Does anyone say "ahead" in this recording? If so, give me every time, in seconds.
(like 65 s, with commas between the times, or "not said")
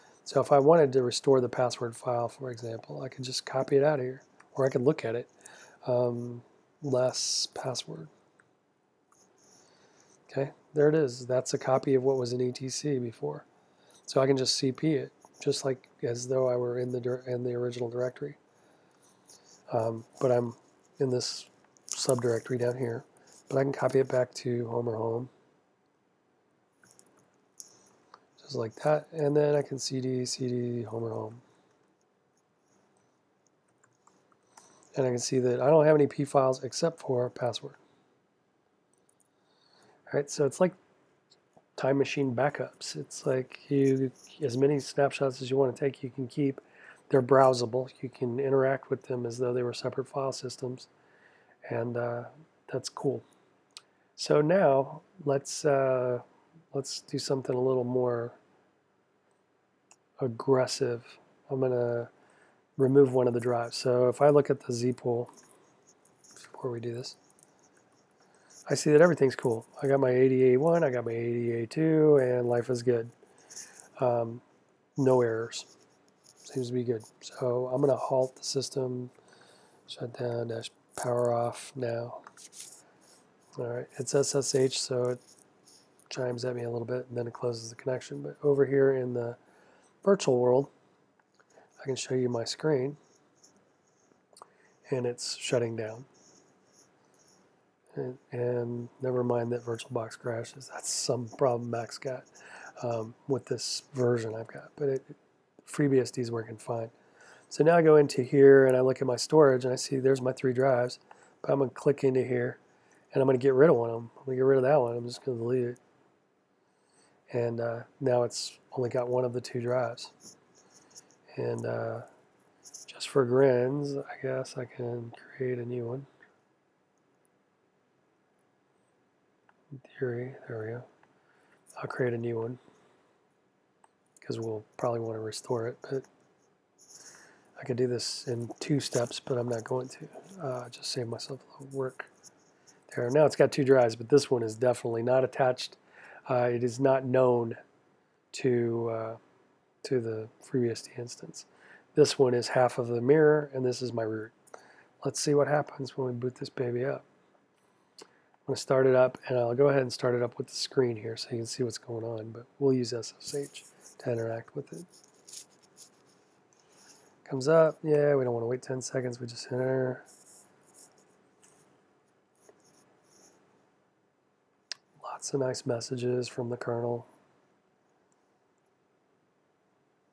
159 s.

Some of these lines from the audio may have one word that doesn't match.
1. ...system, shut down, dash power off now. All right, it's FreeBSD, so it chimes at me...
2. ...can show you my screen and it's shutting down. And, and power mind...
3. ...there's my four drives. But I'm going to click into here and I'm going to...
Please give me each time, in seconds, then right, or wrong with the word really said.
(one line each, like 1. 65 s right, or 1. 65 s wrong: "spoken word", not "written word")
1. 78 s wrong: "SSH", not "FreeBSD"
2. 91 s wrong: "never", not "power"
3. 109 s wrong: "three", not "four".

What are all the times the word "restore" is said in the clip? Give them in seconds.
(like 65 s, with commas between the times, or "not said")
1 s, 135 s.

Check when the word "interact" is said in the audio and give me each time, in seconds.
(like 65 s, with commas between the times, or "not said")
48 s, 164 s.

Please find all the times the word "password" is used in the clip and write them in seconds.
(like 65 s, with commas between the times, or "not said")
1 s, 7 s, 37 s.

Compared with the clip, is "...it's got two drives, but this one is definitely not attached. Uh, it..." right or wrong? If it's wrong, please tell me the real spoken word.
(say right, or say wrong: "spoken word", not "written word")
right.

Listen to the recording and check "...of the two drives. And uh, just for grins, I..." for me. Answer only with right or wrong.
right.